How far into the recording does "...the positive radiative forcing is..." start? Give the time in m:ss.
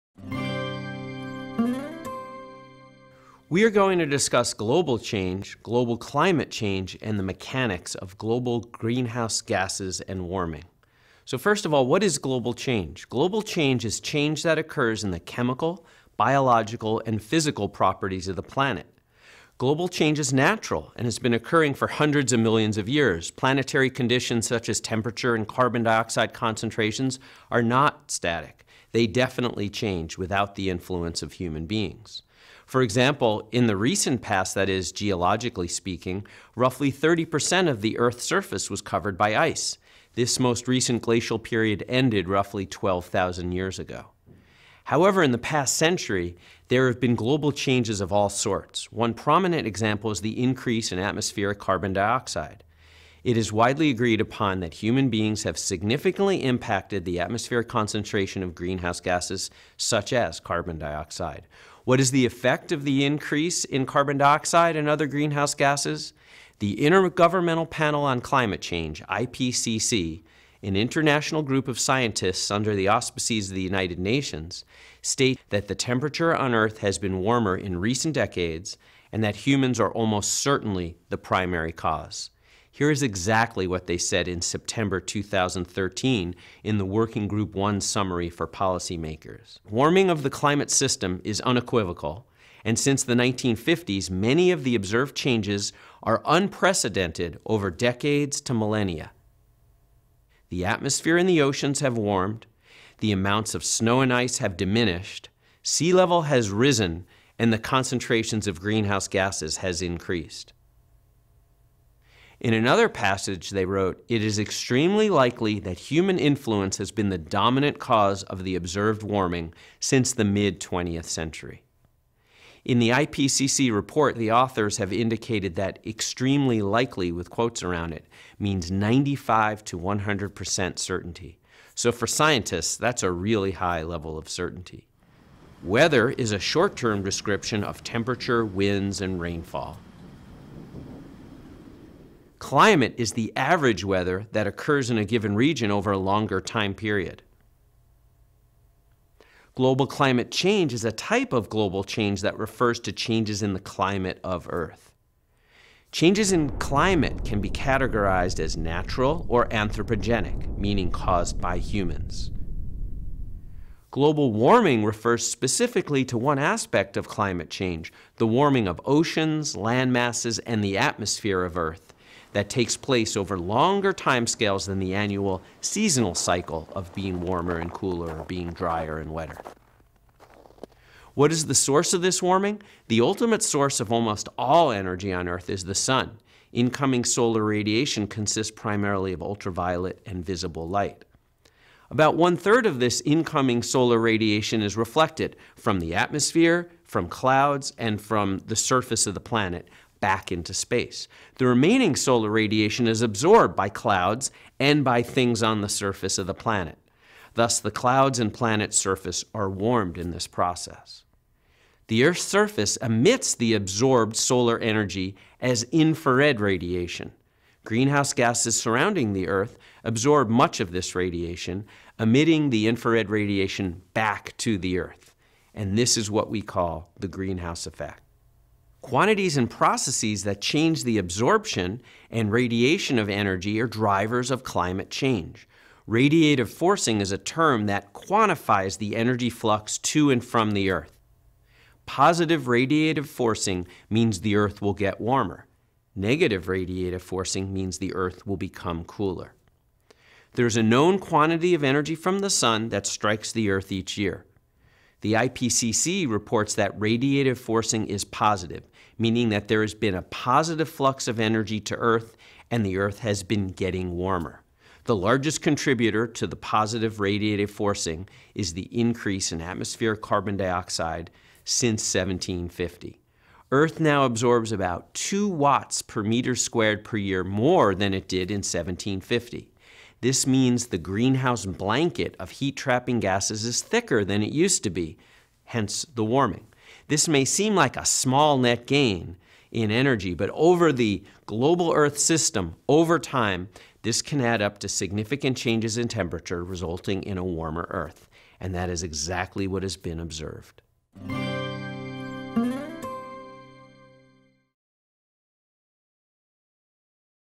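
4:26.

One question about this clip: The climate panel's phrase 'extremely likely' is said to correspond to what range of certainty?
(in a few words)
95 to 100%.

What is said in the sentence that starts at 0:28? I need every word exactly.
They definitely change without the influence of human beings.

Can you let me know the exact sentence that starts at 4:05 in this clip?
Negative radiative forcing means the Earth will become cooler.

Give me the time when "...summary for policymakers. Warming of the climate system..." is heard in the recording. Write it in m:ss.
1:27.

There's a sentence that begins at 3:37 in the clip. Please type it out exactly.
Greenhouse gases surrounding the Earth absorb much of this radiation, emitting the infrared radiation back to the Earth.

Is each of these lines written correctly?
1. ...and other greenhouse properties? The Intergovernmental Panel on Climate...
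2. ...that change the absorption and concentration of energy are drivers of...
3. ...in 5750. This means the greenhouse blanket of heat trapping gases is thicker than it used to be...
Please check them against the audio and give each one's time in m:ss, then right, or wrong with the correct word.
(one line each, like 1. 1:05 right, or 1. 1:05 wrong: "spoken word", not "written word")
1. 1:04 wrong: "gases", not "properties"
2. 3:50 wrong: "radiation", not "concentration"
3. 4:38 wrong: "1750", not "5750".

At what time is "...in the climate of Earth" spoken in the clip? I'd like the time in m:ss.
2:33.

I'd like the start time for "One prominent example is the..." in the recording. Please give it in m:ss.
0:48.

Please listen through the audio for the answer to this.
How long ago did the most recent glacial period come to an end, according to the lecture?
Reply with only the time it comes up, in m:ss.
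0:42.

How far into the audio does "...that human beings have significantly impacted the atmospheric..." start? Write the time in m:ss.
0:54.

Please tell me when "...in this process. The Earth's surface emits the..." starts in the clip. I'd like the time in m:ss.
3:29.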